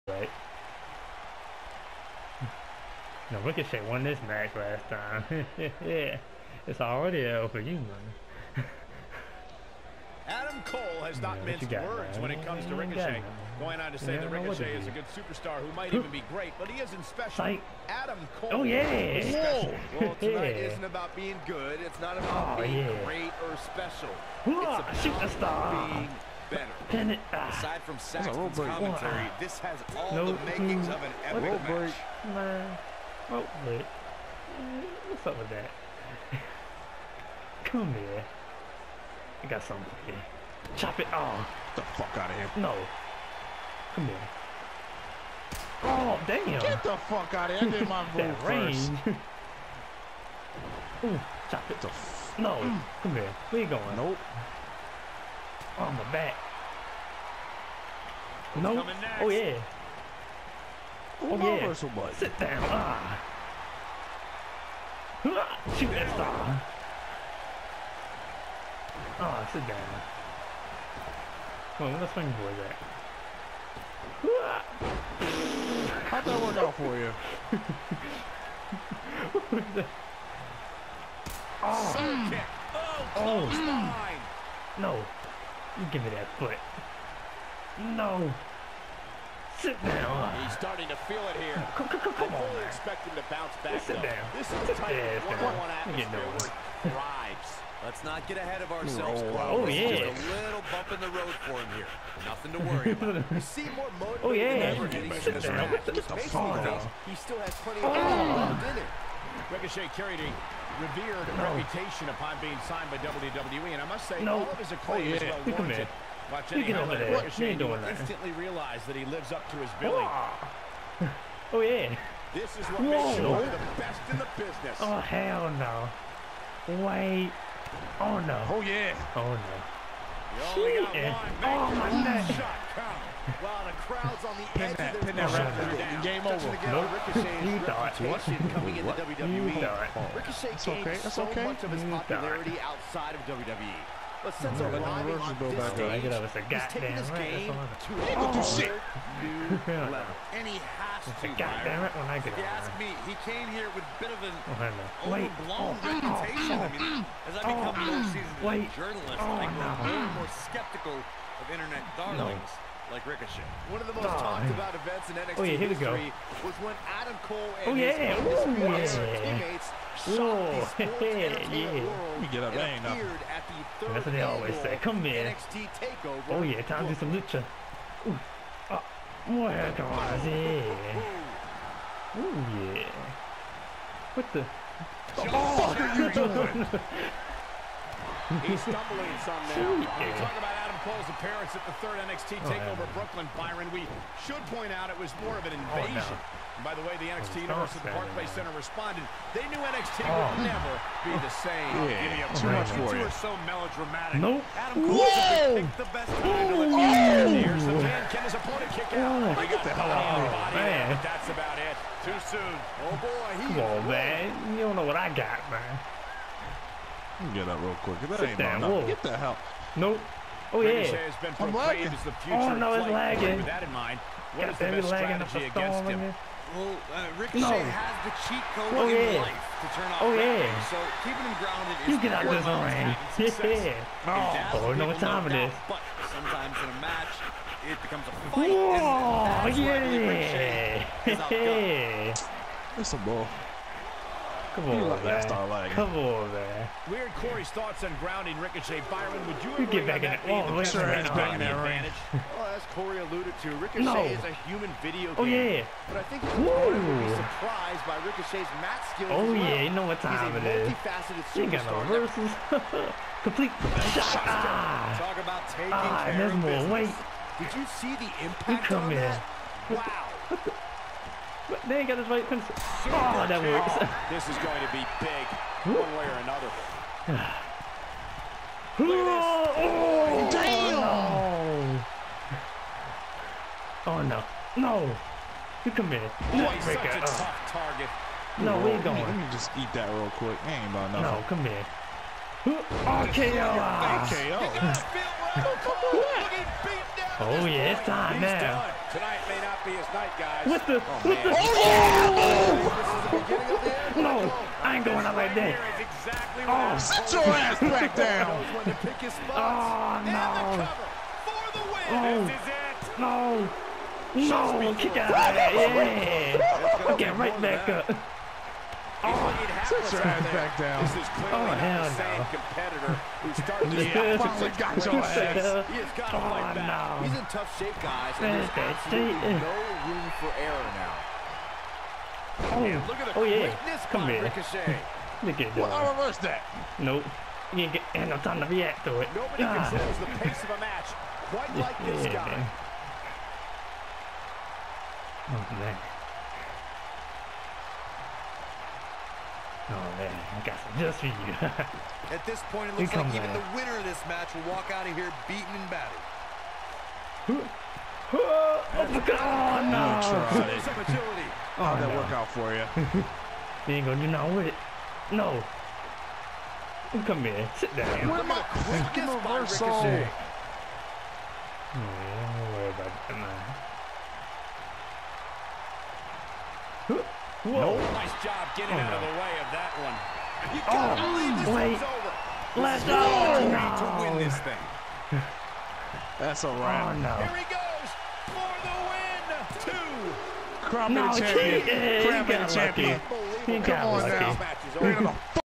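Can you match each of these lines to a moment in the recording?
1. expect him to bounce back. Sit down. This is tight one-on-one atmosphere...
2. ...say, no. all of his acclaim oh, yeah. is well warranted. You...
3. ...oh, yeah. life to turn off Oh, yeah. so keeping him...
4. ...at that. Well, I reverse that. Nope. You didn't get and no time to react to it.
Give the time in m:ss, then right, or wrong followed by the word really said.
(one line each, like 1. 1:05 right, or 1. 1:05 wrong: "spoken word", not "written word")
1. 1:32 right
2. 1:54 right
3. 3:48 right
4. 5:35 right.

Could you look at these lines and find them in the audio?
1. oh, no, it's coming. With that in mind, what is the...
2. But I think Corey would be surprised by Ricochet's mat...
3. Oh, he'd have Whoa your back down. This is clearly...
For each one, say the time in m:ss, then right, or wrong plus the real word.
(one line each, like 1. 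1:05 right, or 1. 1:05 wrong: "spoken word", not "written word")
1. 3:42 wrong: "lagging", not "coming"
2. 4:15 right
3. 5:19 wrong: "Sit", not "Whoa".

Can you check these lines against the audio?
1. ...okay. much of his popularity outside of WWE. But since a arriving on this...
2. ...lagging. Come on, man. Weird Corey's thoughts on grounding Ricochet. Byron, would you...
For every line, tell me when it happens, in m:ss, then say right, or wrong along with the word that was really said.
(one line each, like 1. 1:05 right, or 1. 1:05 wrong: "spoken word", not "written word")
1. 2:21 right
2. 4:05 right.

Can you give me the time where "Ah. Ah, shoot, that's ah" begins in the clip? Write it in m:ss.
1:02.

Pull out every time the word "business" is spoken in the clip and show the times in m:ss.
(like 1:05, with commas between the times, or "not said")
2:04, 4:26.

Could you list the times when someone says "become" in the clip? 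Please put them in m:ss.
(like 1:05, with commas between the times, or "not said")
2:37, 3:57.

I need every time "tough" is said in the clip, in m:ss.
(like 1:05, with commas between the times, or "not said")
4:47, 5:27.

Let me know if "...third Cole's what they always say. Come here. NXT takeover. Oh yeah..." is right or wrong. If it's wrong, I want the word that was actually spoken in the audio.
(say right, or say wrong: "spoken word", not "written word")
wrong: "That", not "Cole".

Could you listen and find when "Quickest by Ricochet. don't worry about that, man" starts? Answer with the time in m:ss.
6:08.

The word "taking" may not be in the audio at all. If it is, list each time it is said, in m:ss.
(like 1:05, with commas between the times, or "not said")
2:26, 4:25.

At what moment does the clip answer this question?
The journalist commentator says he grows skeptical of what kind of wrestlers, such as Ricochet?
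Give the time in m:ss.
2:41.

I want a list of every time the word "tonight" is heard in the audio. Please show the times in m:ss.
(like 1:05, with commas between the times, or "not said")
0:20, 4:58.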